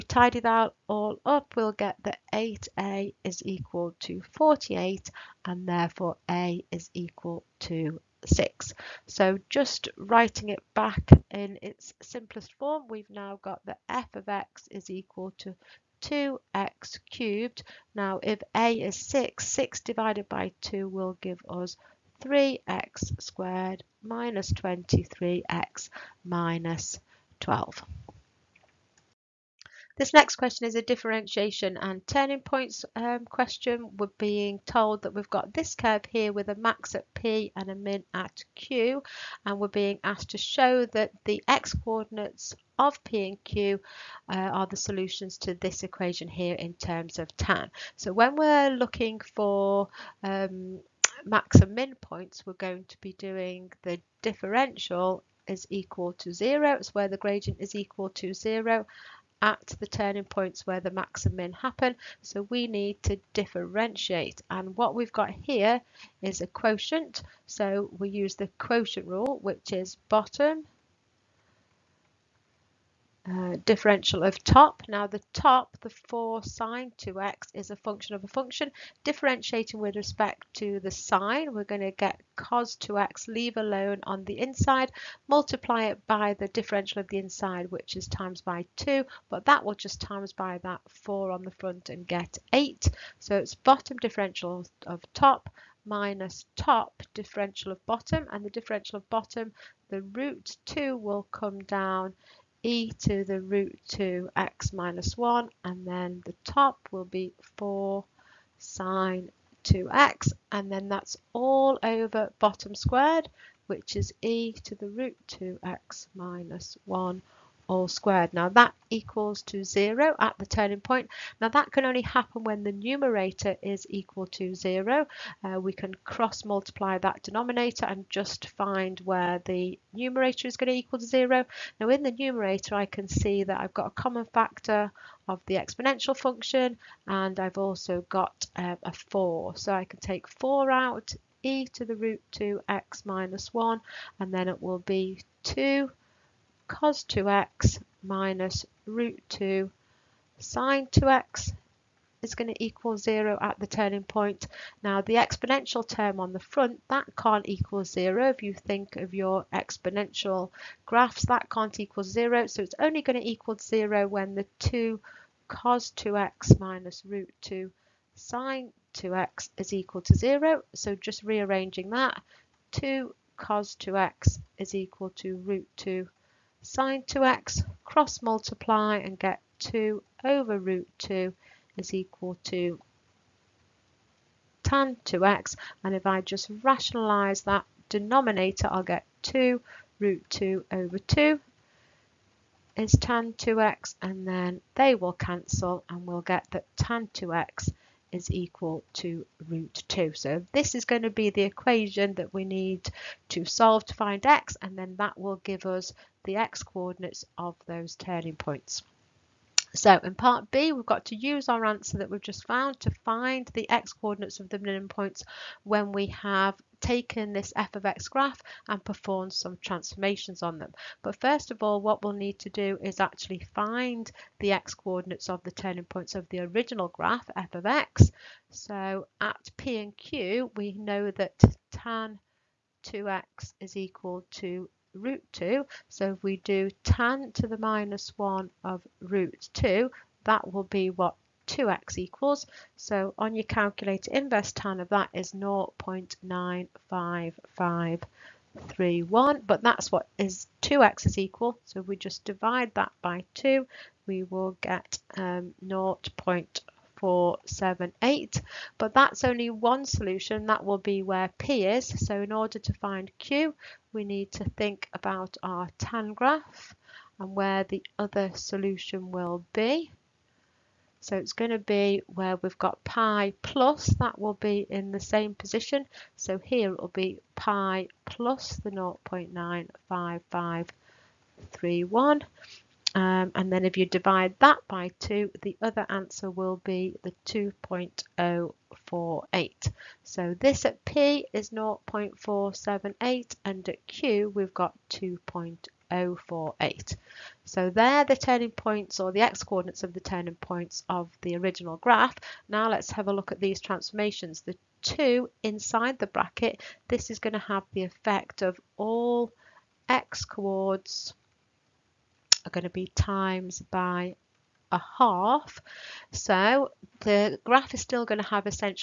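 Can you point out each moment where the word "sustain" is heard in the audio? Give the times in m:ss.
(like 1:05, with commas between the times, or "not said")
not said.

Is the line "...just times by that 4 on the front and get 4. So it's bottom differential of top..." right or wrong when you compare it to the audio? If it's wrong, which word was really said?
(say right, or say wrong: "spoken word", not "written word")
wrong: "8", not "4".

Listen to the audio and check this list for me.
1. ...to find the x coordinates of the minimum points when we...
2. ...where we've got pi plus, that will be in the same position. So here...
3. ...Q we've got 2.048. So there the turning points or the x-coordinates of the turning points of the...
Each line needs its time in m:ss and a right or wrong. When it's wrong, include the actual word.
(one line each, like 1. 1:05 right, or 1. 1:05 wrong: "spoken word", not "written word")
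1. 3:32 right
2. 4:32 right
3. 4:53 right.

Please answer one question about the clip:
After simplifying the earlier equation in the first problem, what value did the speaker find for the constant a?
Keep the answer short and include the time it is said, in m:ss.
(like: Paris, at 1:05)
6, at 0:06.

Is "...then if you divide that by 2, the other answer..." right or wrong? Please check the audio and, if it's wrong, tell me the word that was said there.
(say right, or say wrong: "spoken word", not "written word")
right.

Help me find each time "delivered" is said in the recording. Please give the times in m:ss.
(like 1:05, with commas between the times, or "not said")
not said.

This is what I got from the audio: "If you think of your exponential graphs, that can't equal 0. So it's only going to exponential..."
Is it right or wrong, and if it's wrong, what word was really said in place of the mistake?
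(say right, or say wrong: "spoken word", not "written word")
wrong: "equal", not "exponential".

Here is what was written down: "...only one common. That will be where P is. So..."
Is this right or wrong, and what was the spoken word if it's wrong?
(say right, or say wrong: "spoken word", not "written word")
wrong: "solution", not "common".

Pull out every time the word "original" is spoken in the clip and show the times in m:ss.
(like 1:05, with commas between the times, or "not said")
3:46, 5:01.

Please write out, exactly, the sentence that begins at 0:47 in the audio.
So when we're looking for um, max and min points, we're going to be doing the differential is equal to zero.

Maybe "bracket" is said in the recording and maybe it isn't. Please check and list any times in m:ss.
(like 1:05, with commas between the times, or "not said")
5:06.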